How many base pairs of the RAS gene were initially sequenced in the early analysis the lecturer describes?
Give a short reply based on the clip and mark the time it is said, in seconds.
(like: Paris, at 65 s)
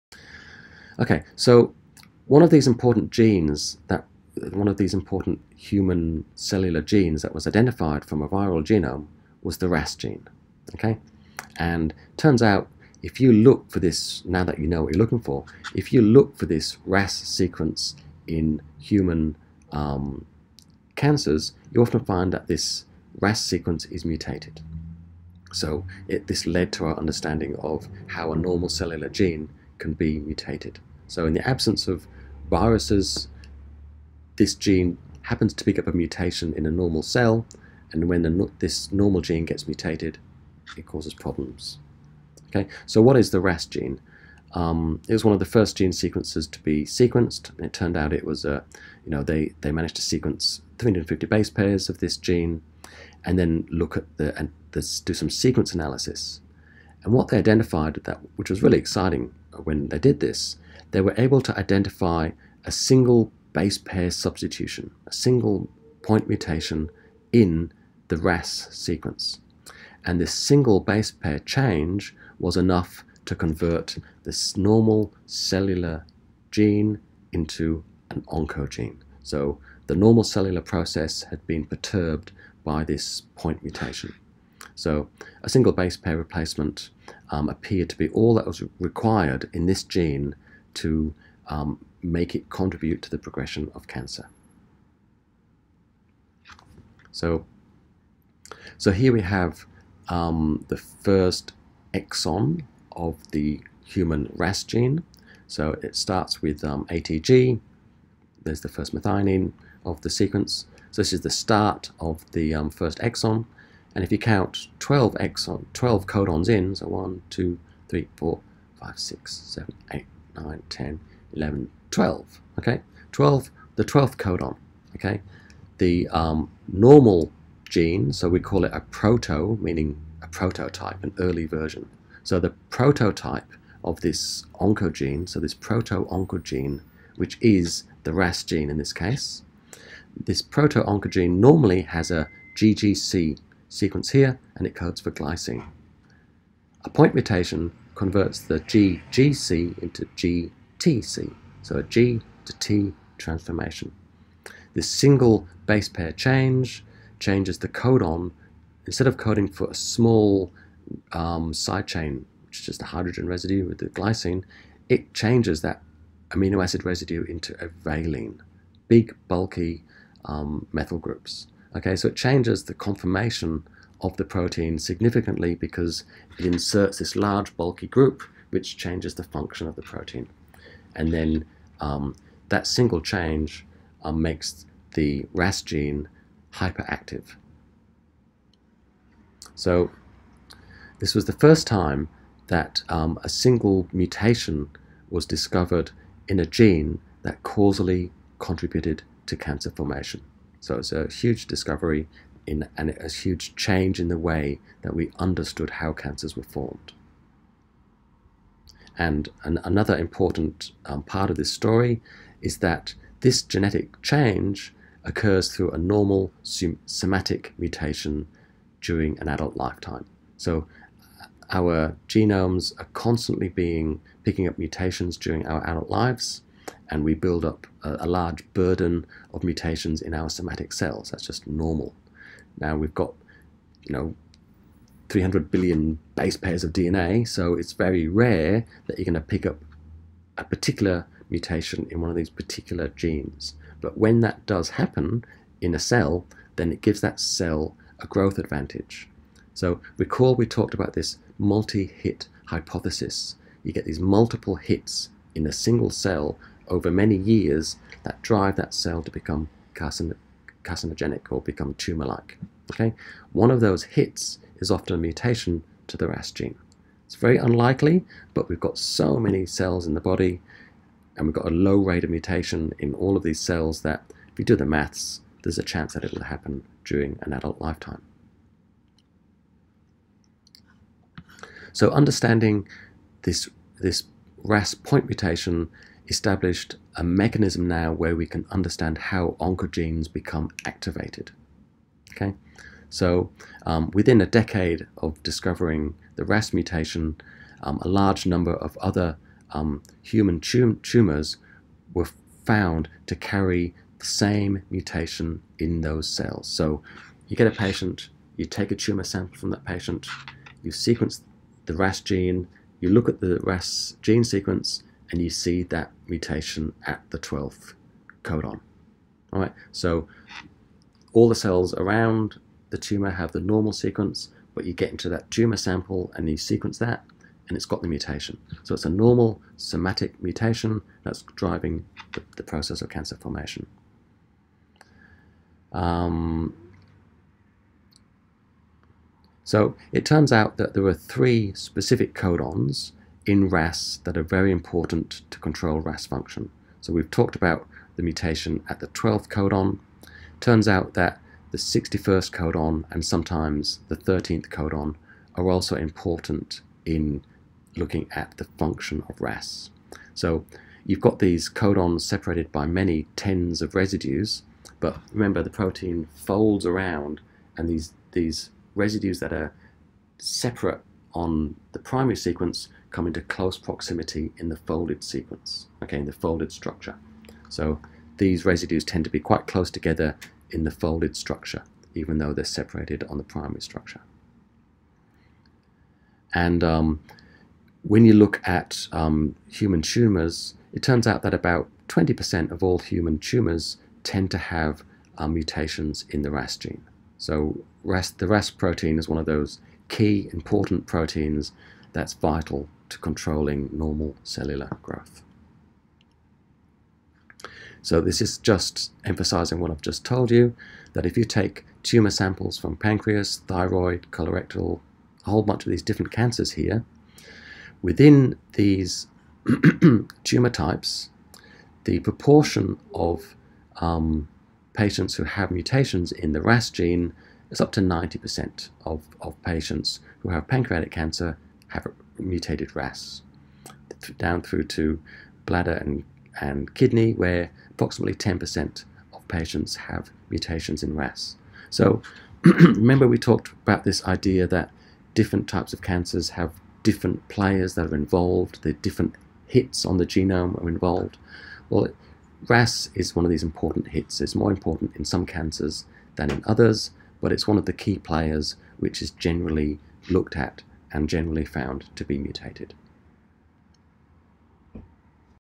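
350, at 50 s.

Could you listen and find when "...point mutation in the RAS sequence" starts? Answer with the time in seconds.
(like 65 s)
66 s.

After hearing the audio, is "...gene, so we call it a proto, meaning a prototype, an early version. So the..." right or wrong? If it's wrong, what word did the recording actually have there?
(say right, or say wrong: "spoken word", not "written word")
right.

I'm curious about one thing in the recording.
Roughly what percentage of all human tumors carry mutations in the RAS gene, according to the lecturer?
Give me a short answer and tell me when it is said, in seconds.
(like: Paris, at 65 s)
20%, at 391 s.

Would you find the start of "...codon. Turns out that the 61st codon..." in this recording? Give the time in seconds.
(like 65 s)
349 s.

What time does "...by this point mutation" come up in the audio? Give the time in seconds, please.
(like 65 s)
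82 s.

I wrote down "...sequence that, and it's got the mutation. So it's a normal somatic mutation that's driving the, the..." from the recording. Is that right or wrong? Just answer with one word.
right.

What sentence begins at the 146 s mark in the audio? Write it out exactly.
A point mutation converts the GGC into GTC, so a G to T transformation.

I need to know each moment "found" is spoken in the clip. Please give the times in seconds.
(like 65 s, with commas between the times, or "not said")
302 s, 461 s.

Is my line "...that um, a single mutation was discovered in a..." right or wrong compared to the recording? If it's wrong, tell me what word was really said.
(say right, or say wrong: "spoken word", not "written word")
right.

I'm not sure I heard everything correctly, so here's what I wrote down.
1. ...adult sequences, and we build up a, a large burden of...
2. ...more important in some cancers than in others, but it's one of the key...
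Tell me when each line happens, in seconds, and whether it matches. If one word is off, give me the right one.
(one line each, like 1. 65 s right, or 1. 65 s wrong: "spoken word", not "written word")
1. 225 s wrong: "lives", not "sequences"
2. 454 s right.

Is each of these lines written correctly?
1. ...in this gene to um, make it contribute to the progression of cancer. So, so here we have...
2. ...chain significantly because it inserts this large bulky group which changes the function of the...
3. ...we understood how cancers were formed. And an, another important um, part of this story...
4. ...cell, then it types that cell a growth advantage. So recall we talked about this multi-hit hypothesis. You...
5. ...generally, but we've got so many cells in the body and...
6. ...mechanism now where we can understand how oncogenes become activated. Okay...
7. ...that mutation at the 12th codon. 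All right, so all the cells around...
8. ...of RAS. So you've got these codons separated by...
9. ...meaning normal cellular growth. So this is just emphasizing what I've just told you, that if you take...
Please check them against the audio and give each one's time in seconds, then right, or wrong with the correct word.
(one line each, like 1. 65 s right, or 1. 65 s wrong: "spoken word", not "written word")
1. 89 s right
2. 174 s wrong: "protein", not "chain"
3. 204 s right
4. 245 s wrong: "gives", not "types"
5. 267 s wrong: "unlikely", not "generally"
6. 287 s right
7. 315 s right
8. 359 s right
9. 402 s wrong: "controlling", not "meaning".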